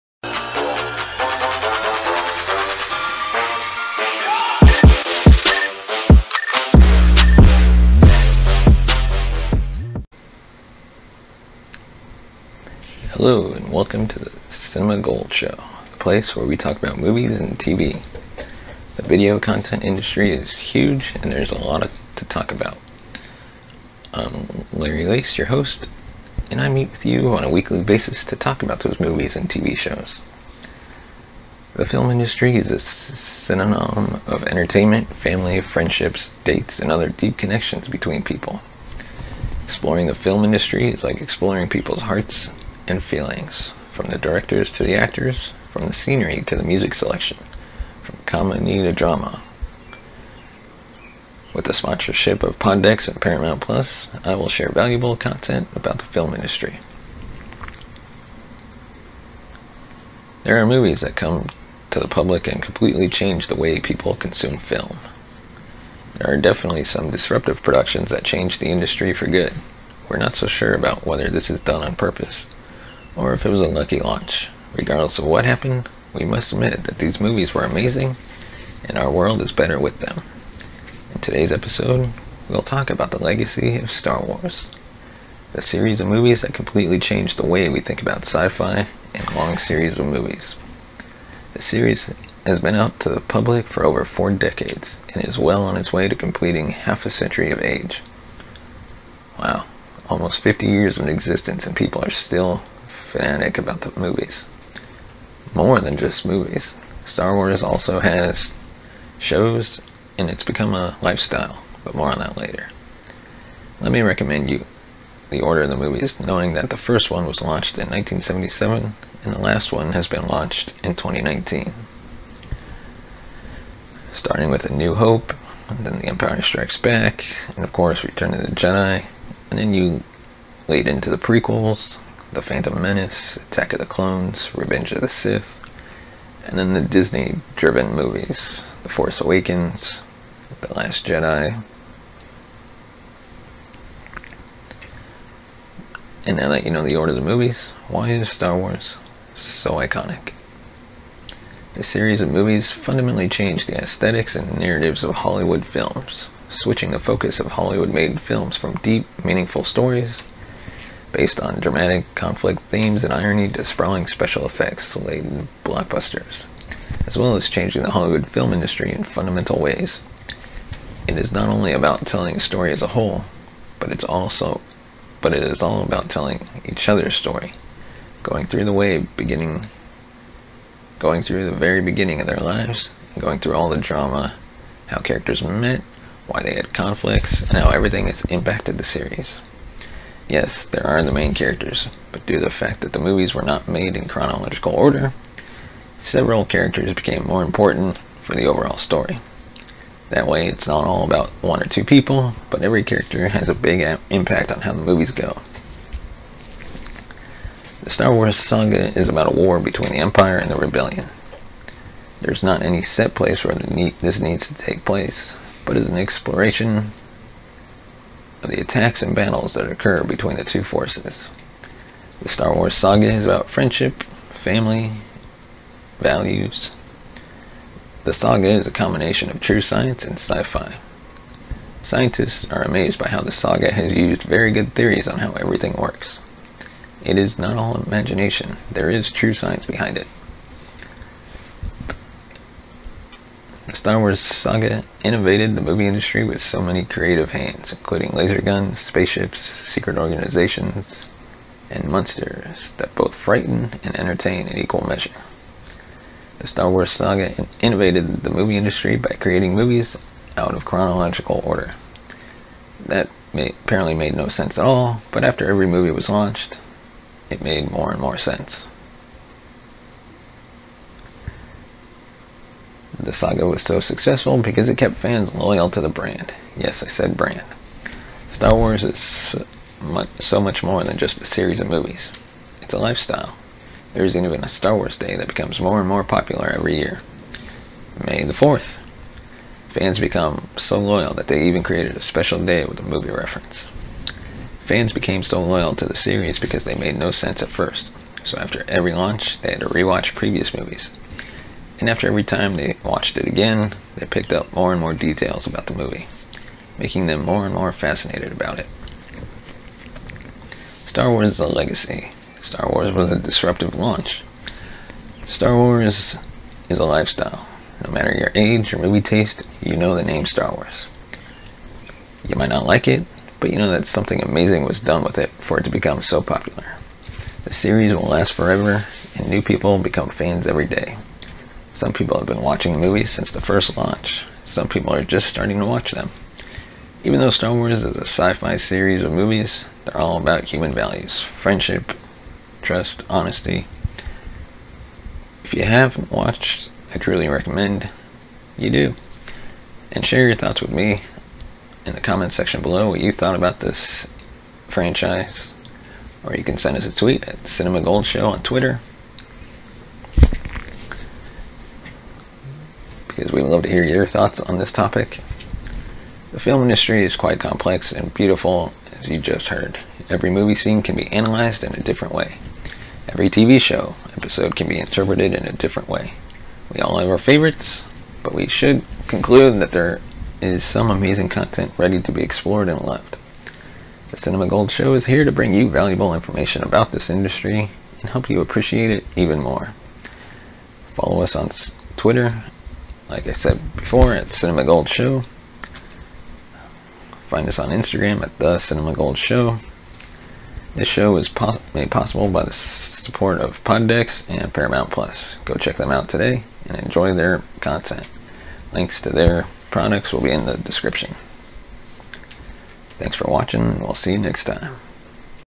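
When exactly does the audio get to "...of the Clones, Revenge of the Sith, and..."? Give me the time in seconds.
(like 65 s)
133 s.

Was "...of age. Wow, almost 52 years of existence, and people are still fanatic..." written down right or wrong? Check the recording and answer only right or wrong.
wrong.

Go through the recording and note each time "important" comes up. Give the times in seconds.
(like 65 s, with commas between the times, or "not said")
197 s.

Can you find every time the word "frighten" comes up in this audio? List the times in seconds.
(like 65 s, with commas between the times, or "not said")
253 s.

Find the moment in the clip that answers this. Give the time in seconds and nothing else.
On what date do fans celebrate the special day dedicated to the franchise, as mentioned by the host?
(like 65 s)
288 s.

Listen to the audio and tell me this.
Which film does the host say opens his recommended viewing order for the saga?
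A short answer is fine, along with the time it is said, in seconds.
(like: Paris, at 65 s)
A New Hope, at 124 s.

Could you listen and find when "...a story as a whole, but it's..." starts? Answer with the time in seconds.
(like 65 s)
172 s.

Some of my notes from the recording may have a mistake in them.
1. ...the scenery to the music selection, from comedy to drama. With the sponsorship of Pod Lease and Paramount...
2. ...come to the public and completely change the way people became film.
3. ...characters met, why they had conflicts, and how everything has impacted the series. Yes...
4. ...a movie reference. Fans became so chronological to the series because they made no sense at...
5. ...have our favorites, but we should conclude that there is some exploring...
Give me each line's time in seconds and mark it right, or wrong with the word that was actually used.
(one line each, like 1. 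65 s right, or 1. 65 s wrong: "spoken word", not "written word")
1. 45 s wrong: "Decks", not "Lease"
2. 61 s wrong: "consume", not "became"
3. 184 s right
4. 292 s wrong: "loyal", not "chronological"
5. 376 s wrong: "amazing", not "exploring".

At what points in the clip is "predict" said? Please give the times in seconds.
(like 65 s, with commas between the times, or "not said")
not said.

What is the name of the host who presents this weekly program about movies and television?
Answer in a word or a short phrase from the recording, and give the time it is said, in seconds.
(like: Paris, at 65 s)
Larry Lease, at 24 s.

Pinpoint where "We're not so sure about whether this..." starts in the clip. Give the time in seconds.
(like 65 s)
70 s.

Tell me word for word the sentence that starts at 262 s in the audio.
That may, apparently made no sense at all, but after every movie was launched, it made more and more sense.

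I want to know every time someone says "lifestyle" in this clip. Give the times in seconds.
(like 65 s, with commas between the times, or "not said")
111 s, 282 s, 316 s.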